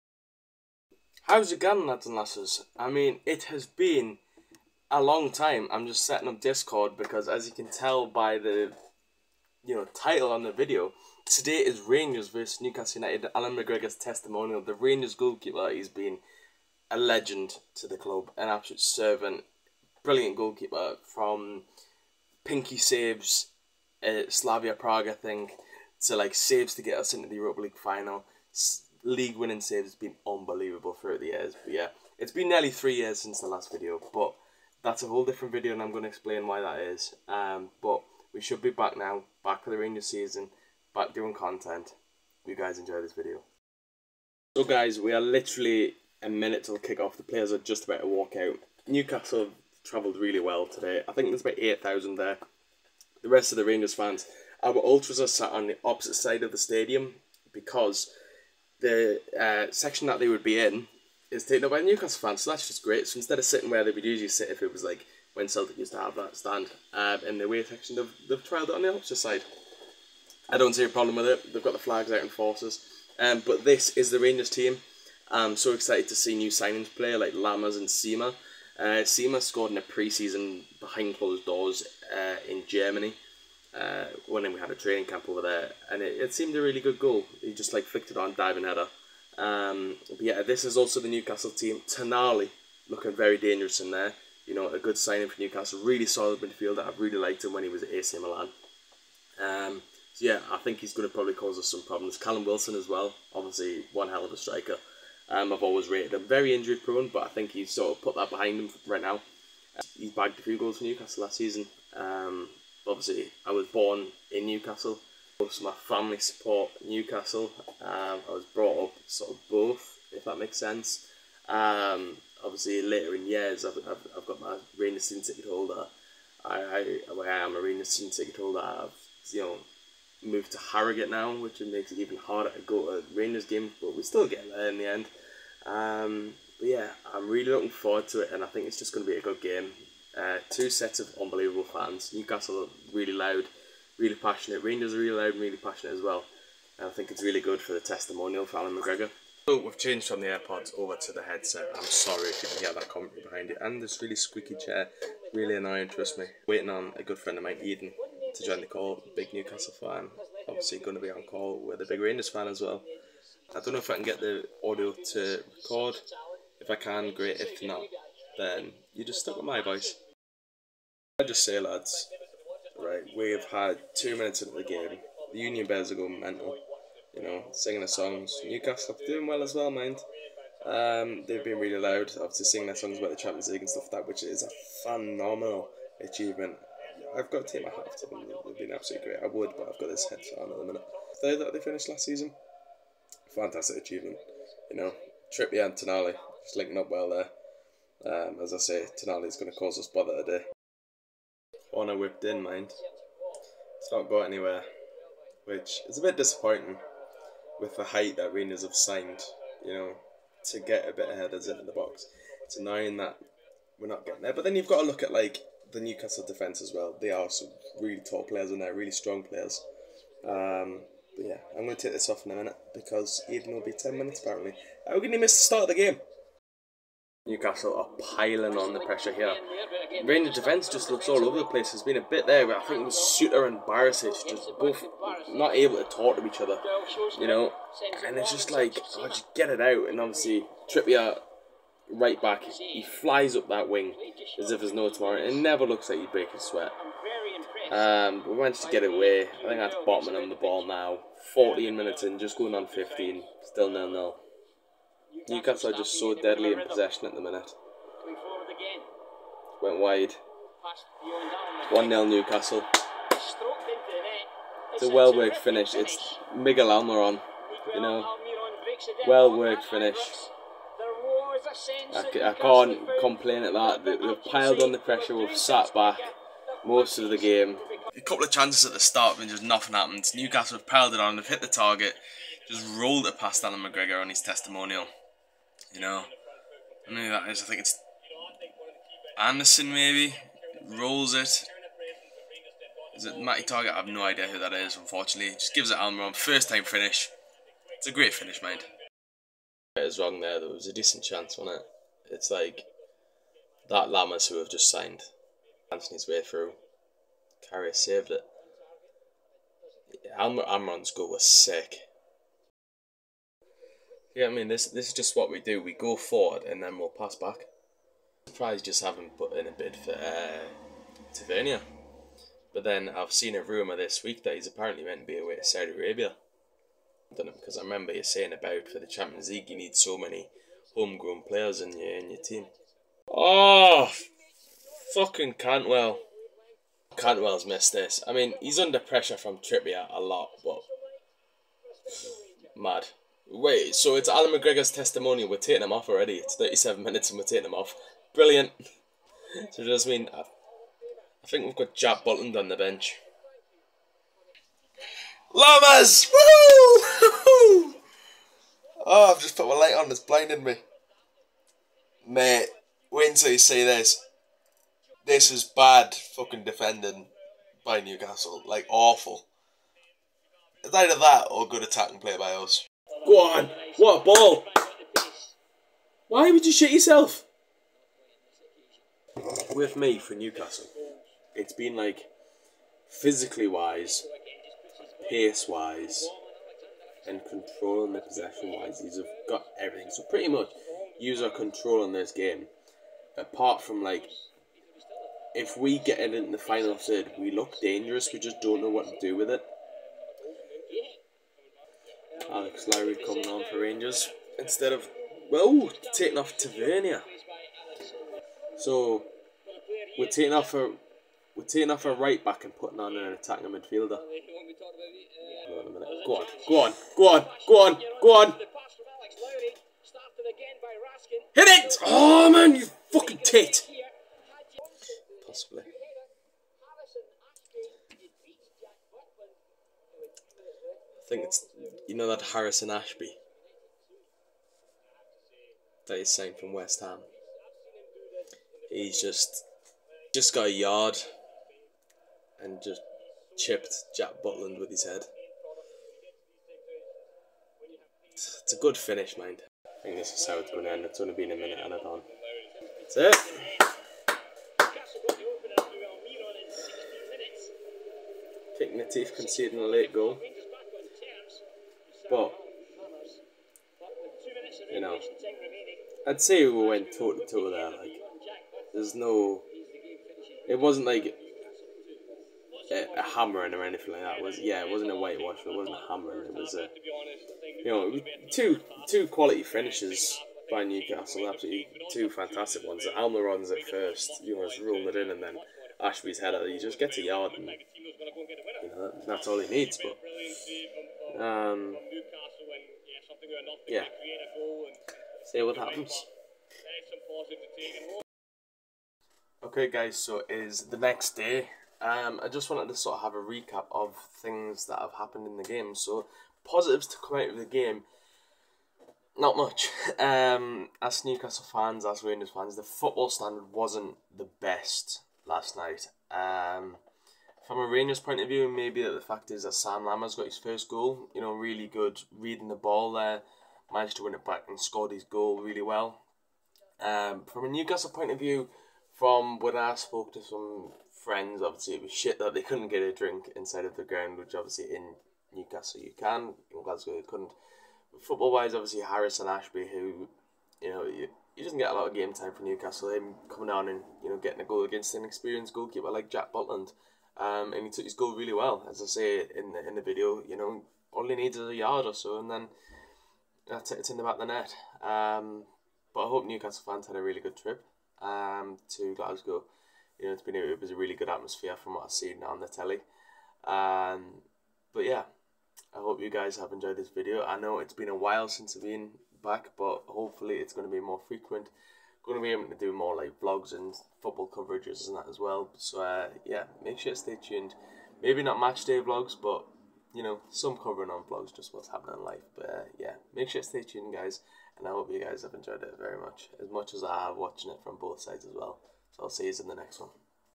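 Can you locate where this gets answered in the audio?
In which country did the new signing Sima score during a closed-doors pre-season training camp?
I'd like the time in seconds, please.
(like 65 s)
82 s.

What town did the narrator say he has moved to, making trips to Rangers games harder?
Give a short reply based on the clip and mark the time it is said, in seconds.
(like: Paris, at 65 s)
Harrogate, at 130 s.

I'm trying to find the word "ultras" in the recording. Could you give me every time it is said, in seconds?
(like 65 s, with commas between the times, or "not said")
54 s.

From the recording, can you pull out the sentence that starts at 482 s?
The Almiron's at first, you know, just rolling it in, and then Ashby's header.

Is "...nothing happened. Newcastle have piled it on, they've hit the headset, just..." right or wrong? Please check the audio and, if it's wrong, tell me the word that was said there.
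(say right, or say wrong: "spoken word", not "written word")
wrong: "target", not "headset".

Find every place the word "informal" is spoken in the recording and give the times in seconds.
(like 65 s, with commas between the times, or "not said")
not said.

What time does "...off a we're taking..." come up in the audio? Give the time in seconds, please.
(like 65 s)
410 s.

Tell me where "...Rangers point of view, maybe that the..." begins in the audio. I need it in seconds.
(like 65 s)
517 s.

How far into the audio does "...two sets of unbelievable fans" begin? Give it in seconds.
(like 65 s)
140 s.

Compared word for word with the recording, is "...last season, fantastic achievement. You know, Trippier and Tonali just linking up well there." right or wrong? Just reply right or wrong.
right.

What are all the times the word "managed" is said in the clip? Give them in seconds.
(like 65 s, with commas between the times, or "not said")
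248 s, 523 s.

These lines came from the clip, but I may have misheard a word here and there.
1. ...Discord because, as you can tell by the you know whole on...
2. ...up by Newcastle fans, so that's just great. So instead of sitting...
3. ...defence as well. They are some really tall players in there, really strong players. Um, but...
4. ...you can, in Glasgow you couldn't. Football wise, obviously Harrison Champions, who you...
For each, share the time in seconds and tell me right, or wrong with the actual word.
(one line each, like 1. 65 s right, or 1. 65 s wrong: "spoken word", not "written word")
1. 6 s wrong: "title", not "whole"
2. 61 s right
3. 216 s right
4. 535 s wrong: "Ashby", not "Champions".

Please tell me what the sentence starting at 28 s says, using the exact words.
S league winning saves has been unbelievable throughout the years.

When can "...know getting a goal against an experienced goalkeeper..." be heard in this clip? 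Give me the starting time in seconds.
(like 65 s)
544 s.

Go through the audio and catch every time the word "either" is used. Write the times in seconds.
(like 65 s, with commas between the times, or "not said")
370 s.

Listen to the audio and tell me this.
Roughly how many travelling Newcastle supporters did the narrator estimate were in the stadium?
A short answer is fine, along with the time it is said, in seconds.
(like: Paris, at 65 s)
8,000, at 51 s.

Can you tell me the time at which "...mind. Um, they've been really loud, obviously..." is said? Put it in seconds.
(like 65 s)
179 s.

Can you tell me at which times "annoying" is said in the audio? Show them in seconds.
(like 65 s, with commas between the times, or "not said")
155 s, 212 s.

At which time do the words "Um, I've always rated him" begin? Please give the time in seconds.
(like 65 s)
105 s.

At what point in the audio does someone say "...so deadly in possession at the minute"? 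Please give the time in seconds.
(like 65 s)
255 s.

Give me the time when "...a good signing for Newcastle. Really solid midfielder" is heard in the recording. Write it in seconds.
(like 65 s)
94 s.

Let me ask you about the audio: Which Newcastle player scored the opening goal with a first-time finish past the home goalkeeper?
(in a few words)
Miguel Almiron.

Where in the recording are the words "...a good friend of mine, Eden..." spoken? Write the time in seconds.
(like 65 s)
156 s.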